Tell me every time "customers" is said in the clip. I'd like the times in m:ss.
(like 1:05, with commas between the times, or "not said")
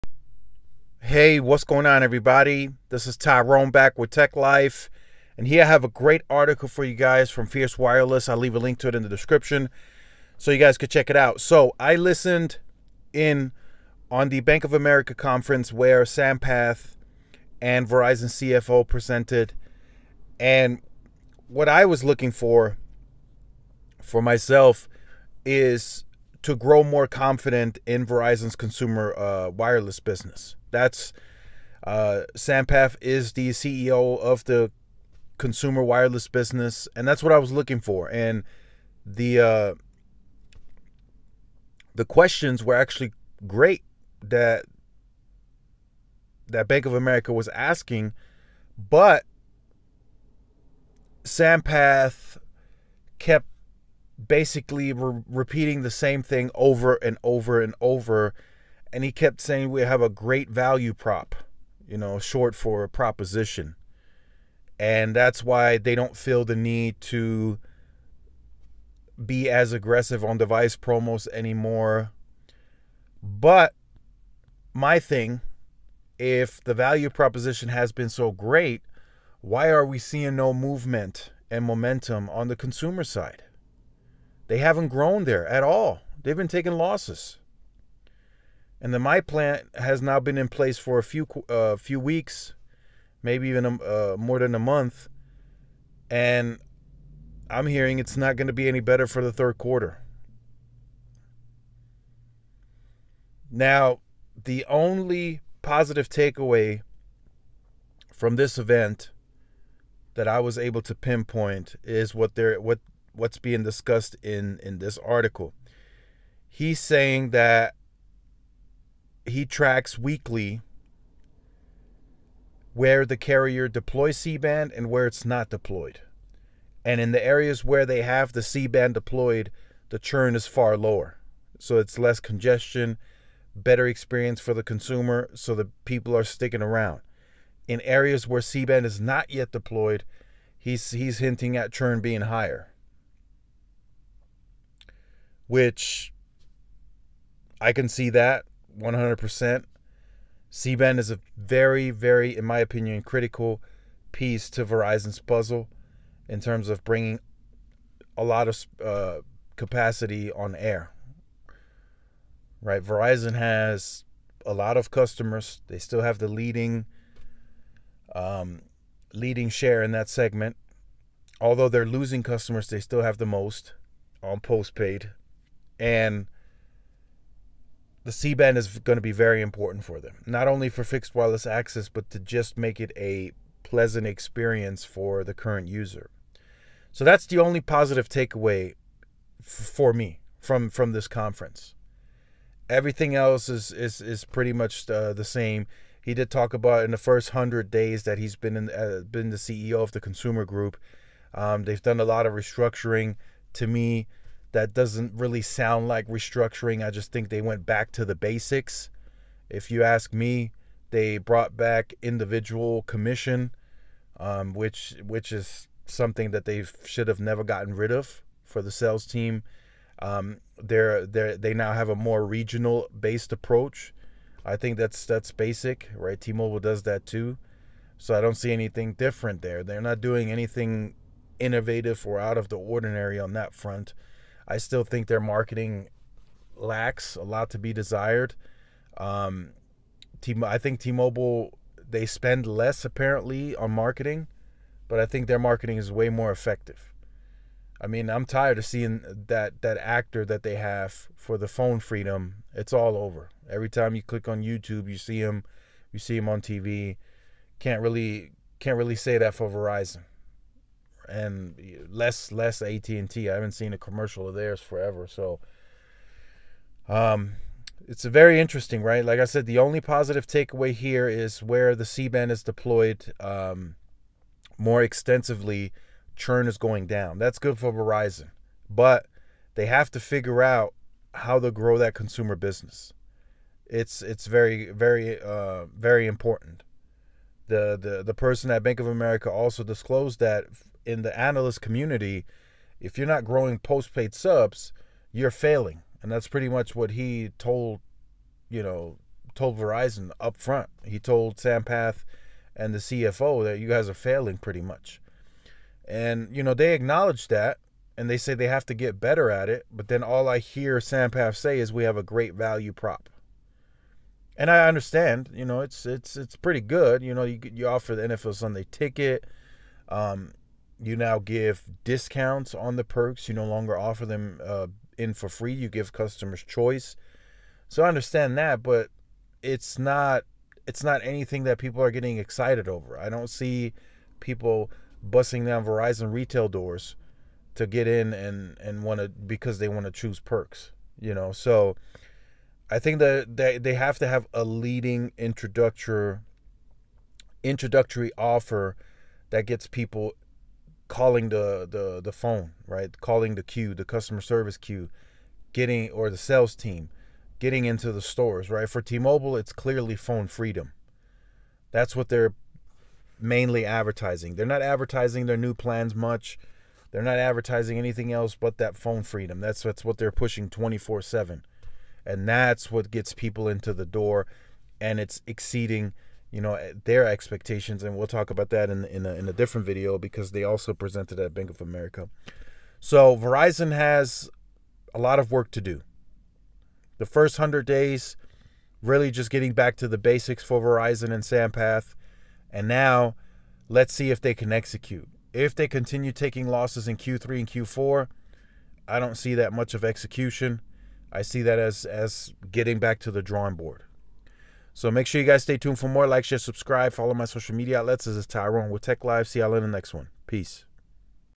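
2:44, 2:52, 5:25, 5:53.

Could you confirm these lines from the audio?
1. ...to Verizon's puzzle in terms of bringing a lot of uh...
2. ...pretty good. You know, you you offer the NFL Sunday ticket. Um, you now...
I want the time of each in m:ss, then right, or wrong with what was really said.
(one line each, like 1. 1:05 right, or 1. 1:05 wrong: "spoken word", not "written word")
1. 2:34 right
2. 5:16 right.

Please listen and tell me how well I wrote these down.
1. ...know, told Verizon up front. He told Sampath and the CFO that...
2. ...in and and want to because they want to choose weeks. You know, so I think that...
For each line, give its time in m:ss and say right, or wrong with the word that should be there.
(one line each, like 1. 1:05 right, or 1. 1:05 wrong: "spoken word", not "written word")
1. 4:58 right
2. 5:37 wrong: "perks", not "weeks".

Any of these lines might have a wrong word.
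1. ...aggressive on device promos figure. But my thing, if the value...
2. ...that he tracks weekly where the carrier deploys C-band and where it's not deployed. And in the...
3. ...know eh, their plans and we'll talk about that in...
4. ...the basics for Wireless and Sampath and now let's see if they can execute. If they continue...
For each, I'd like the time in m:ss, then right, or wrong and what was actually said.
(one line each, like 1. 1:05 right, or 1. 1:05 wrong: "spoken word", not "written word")
1. 1:09 wrong: "anymore", not "figure"
2. 1:57 right
3. 6:16 wrong: "expectations", not "plans"
4. 6:29 wrong: "Verizon", not "Wireless".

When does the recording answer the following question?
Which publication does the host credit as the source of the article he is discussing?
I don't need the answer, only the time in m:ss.
0:07.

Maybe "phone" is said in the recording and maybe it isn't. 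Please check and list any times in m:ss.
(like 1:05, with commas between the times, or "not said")
4:11, 5:52, 5:59, 6:08.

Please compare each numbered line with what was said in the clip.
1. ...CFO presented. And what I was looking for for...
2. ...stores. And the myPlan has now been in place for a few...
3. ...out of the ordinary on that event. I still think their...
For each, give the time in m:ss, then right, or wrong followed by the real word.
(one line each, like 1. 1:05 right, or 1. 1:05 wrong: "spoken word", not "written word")
1. 0:18 right
2. 1:26 wrong: "losses", not "stores"
3. 3:52 wrong: "front", not "event".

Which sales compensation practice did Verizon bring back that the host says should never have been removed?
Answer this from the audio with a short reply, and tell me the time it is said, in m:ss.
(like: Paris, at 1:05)
Individual commission, at 3:32.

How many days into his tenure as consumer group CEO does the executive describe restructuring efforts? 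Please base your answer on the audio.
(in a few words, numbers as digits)
100.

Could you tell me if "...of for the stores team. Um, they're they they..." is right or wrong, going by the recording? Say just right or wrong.
wrong.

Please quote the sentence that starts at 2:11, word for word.
So it's less congestion, better experience for the consumer, so the people are sticking around.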